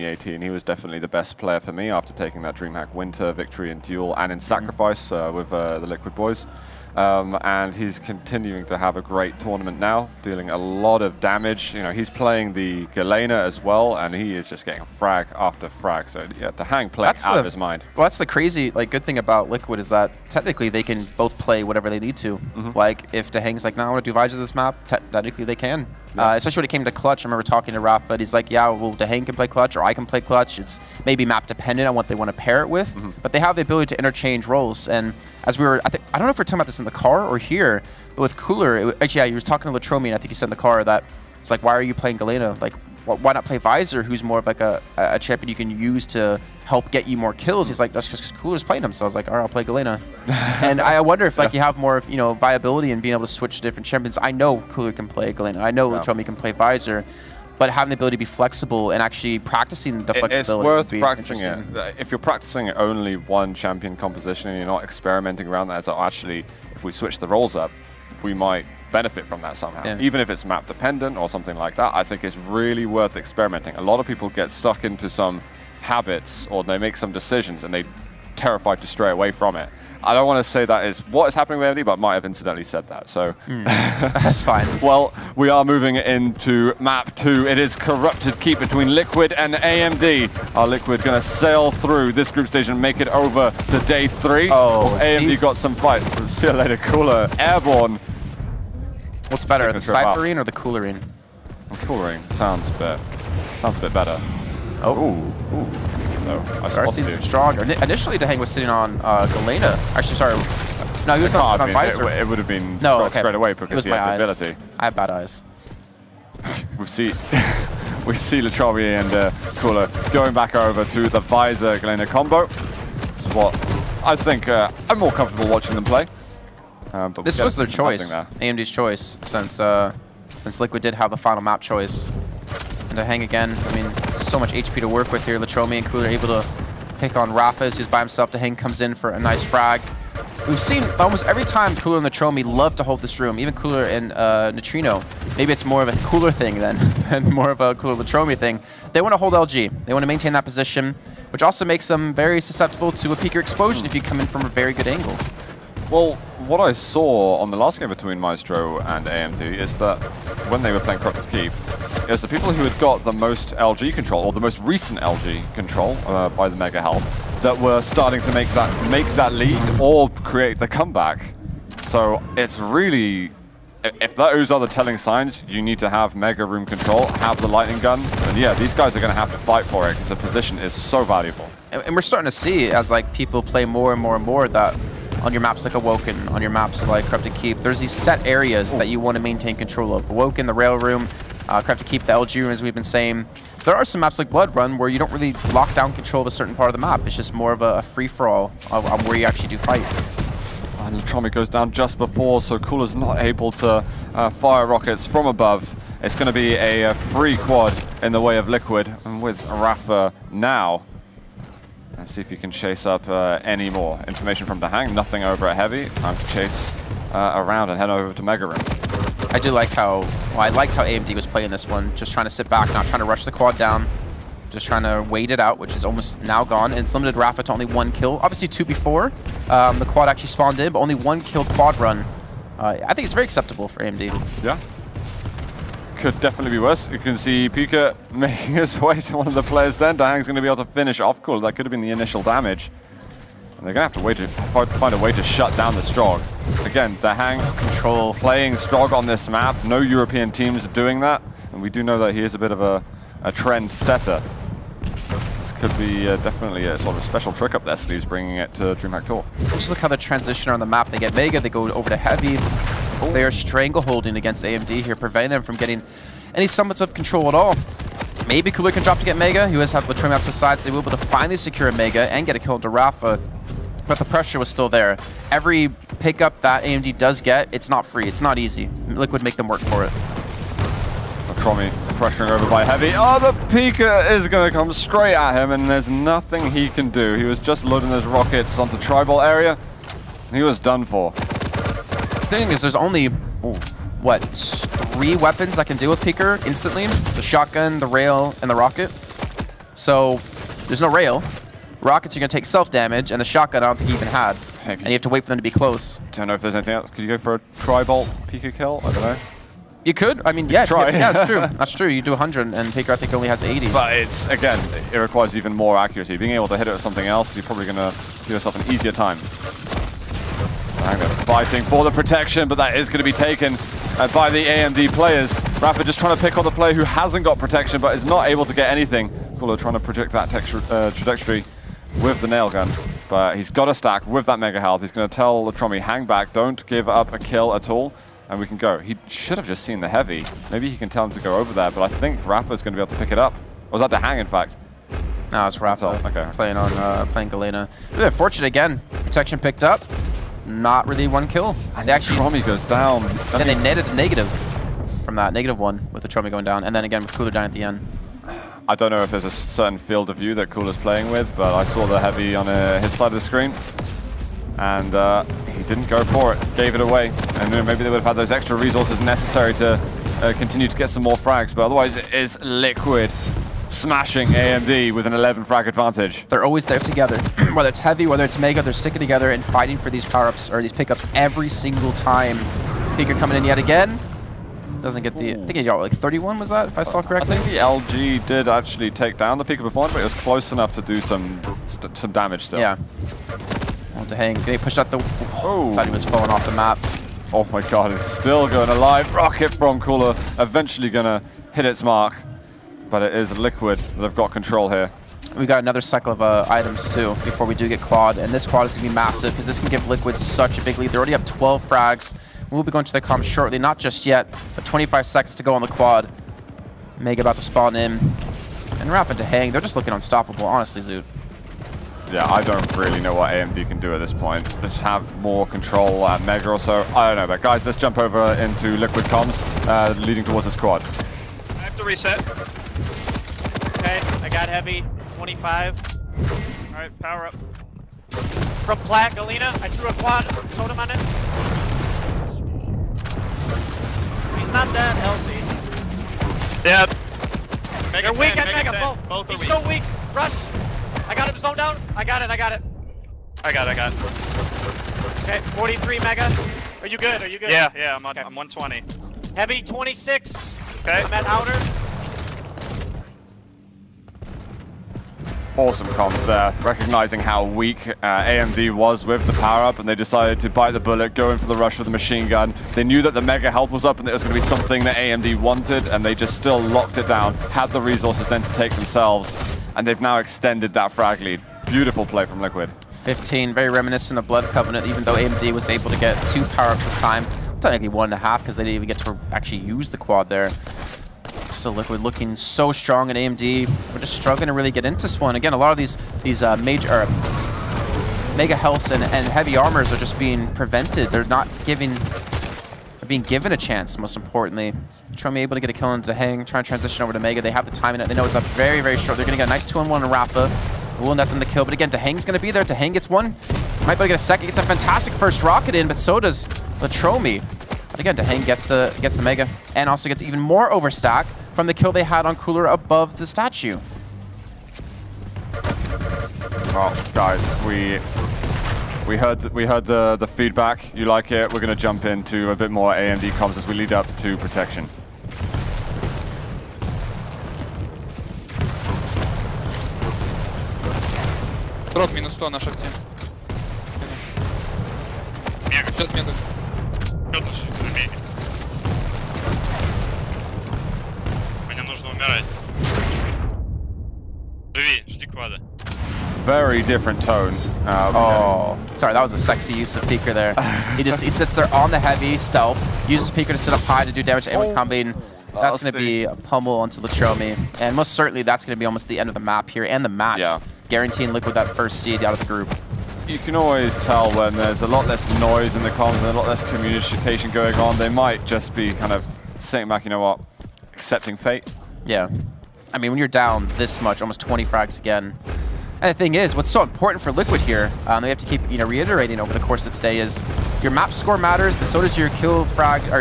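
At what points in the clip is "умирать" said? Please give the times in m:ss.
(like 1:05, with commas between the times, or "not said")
9:12.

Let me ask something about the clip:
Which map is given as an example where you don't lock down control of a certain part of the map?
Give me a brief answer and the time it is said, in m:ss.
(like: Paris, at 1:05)
Blood Run, at 3:14.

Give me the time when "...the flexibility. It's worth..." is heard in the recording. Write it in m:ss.
1:00.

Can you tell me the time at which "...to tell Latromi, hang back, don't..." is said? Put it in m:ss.
5:35.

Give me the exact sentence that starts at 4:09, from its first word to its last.
No European teams are doing that.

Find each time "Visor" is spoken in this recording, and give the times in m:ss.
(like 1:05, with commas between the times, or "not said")
0:43, 0:56, 1:51, 2:01.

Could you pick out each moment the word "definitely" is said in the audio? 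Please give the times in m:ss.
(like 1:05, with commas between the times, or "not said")
0:00, 3:56, 4:16.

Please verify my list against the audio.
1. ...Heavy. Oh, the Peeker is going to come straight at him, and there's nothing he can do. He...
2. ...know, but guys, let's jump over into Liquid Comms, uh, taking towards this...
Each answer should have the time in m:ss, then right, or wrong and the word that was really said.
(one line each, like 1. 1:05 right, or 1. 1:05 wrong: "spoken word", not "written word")
1. 4:42 right
2. 7:07 wrong: "leading", not "taking".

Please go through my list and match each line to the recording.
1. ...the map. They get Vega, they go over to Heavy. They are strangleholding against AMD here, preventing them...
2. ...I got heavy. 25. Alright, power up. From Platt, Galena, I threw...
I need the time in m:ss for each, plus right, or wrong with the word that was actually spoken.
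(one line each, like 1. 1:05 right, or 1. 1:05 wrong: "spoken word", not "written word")
1. 4:20 right
2. 7:14 right.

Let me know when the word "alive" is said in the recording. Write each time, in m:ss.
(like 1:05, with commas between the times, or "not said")
6:38.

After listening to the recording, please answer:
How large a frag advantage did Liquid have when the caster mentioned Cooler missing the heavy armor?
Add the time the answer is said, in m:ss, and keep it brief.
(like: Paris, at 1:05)
11, at 6:15.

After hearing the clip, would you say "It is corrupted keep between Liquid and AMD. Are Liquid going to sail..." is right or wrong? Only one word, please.
right.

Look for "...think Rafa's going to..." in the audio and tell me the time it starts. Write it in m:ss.
5:41.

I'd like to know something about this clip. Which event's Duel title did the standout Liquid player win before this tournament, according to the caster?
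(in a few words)
DreamHack Winter.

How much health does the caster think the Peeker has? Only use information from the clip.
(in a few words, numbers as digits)
80.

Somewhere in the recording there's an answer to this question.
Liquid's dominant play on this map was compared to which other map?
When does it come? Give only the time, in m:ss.
8:04.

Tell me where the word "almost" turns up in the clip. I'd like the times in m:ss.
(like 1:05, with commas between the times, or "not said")
2:20, 3:45, 9:28, 9:44.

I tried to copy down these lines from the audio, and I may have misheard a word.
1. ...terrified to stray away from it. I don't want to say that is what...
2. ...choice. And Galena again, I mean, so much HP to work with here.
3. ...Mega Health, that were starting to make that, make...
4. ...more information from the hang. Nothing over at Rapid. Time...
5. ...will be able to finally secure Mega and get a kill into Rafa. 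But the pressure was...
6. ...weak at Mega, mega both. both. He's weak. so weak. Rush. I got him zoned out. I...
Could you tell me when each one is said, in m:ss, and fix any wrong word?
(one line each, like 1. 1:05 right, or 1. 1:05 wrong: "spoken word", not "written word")
1. 1:18 right
2. 2:11 wrong: "Dehang", not "Galena"
3. 2:46 right
4. 3:33 wrong: "Heavy", not "Rapid"
5. 4:30 right
6. 7:28 right.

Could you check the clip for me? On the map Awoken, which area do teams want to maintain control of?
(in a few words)
Rail Room.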